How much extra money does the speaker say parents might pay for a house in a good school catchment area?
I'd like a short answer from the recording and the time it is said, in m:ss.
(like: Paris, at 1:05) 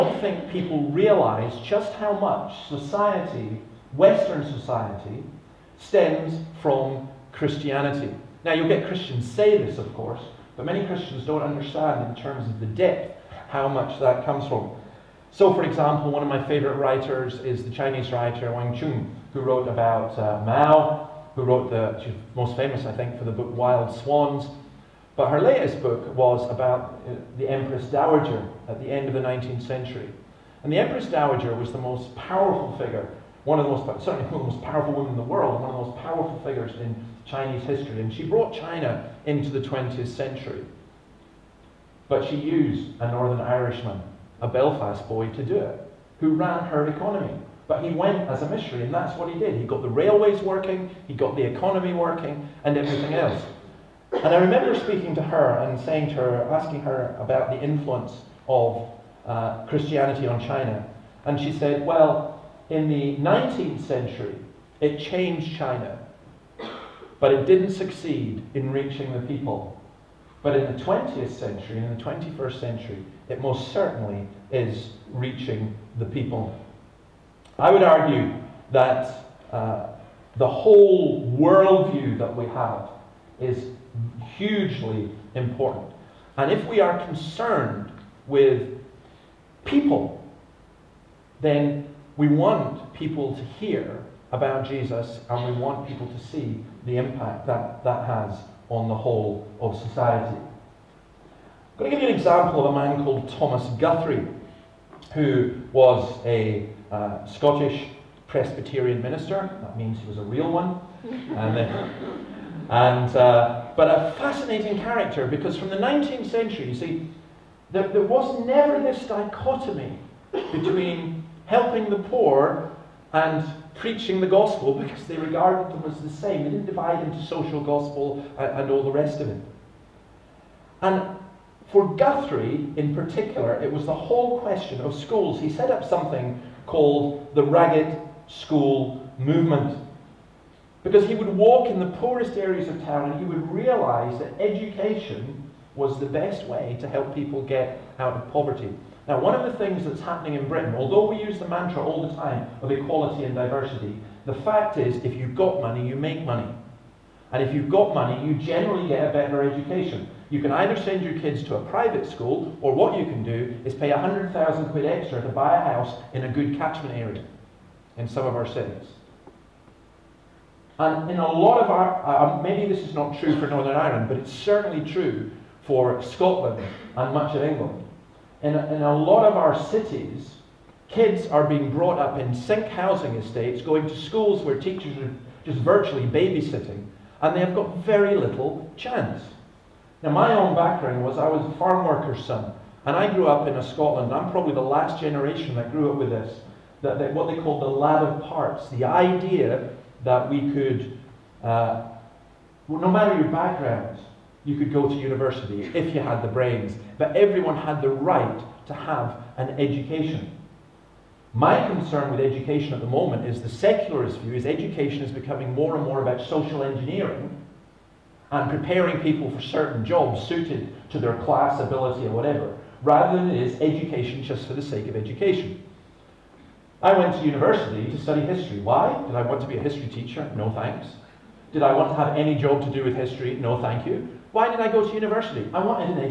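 100,000 quid, at 2:43.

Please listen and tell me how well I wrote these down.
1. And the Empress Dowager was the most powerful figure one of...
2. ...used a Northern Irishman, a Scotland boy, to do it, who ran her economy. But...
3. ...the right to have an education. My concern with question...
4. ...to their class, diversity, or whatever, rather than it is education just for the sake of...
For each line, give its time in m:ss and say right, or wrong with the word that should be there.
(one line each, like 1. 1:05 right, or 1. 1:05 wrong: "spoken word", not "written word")
1. 0:30 right
2. 0:42 wrong: "Belfast", not "Scotland"
3. 3:27 wrong: "education", not "question"
4. 3:40 wrong: "ability", not "diversity".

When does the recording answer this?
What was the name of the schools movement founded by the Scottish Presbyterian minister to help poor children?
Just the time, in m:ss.
2:17.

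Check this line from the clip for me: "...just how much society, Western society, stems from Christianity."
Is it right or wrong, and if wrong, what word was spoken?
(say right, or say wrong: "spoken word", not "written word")
right.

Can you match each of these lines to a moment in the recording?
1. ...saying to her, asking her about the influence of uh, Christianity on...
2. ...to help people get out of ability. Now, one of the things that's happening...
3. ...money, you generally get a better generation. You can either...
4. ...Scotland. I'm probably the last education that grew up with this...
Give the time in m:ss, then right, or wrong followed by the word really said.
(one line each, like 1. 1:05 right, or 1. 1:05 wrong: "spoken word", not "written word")
1. 0:55 right
2. 2:26 wrong: "poverty", not "ability"
3. 2:37 wrong: "education", not "generation"
4. 3:13 wrong: "generation", not "education".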